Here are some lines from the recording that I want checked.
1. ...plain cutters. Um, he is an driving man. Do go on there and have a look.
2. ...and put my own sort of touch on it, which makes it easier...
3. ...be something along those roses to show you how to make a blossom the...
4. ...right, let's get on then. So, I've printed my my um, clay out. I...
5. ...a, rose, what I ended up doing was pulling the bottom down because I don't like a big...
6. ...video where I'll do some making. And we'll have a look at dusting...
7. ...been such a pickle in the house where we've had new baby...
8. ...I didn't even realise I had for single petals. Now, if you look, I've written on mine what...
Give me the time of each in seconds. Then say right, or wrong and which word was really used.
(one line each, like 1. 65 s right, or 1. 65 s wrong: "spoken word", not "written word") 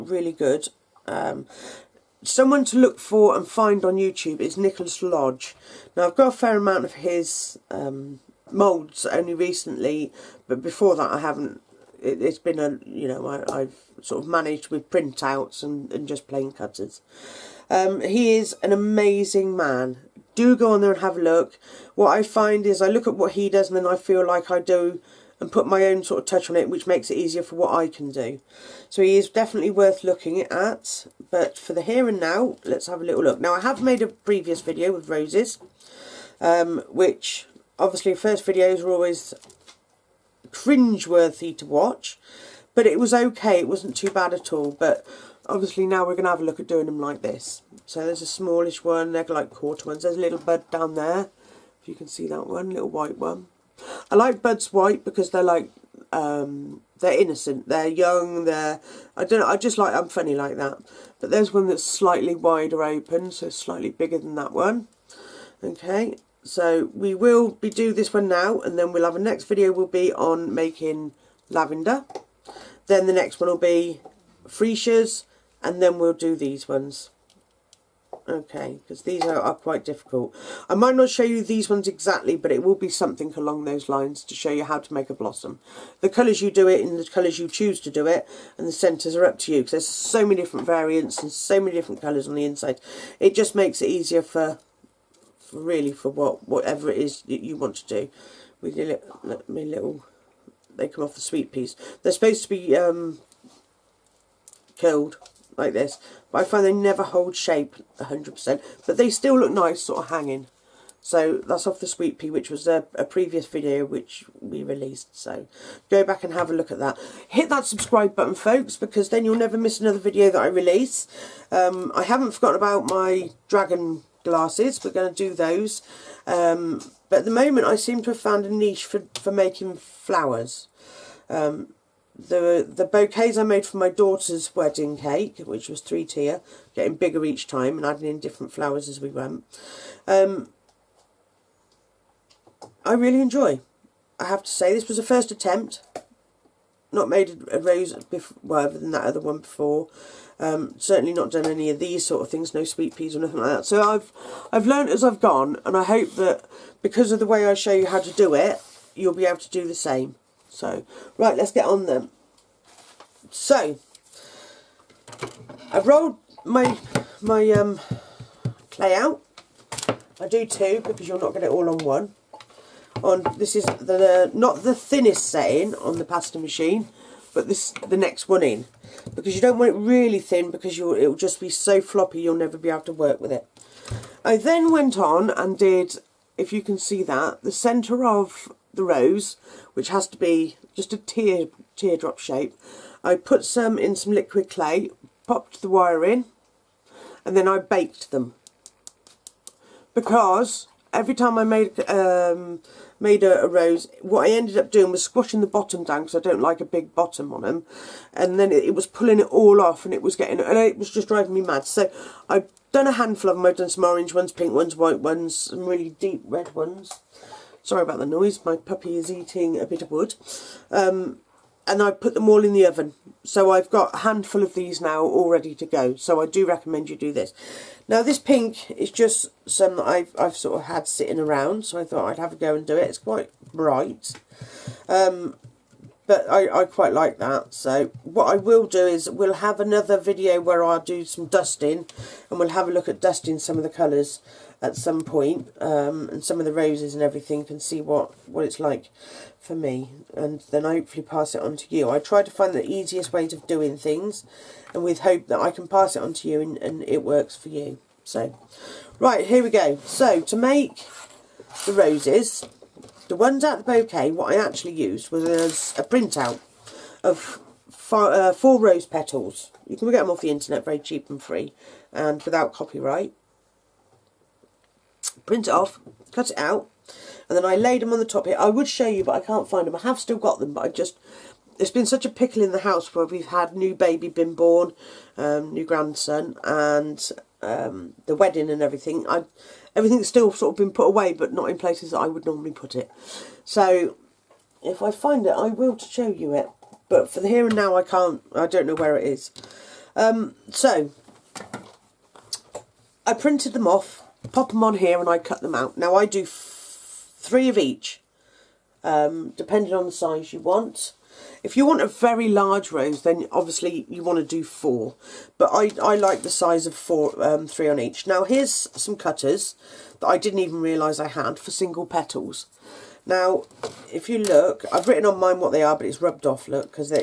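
1. 16 s wrong: "amazing", not "driving"
2. 25 s right
3. 82 s wrong: "lines", not "roses"
4. 161 s wrong: "rolled", not "printed"
5. 203 s wrong: "squashing", not "pulling"
6. 239 s wrong: "dusting", not "making"
7. 281 s right
8. 320 s right.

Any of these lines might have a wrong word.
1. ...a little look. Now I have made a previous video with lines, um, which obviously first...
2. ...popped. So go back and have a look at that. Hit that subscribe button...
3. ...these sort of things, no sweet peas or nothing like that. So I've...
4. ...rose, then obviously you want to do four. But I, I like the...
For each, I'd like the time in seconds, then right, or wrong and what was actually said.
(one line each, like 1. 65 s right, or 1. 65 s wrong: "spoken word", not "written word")
1. 33 s wrong: "roses", not "lines"
2. 114 s wrong: "released", not "popped"
3. 151 s right
4. 312 s right.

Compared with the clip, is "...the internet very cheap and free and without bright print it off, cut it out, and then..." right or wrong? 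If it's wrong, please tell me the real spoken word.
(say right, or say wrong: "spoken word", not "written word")
wrong: "copyright", not "bright".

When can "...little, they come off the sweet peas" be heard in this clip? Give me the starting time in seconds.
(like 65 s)
99 s.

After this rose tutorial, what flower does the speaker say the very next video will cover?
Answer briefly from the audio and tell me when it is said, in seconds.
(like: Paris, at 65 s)
lavender, at 71 s.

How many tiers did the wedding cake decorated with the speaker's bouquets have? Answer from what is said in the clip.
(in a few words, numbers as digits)
3.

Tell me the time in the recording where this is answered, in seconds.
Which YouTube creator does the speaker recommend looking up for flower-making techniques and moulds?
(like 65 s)
4 s.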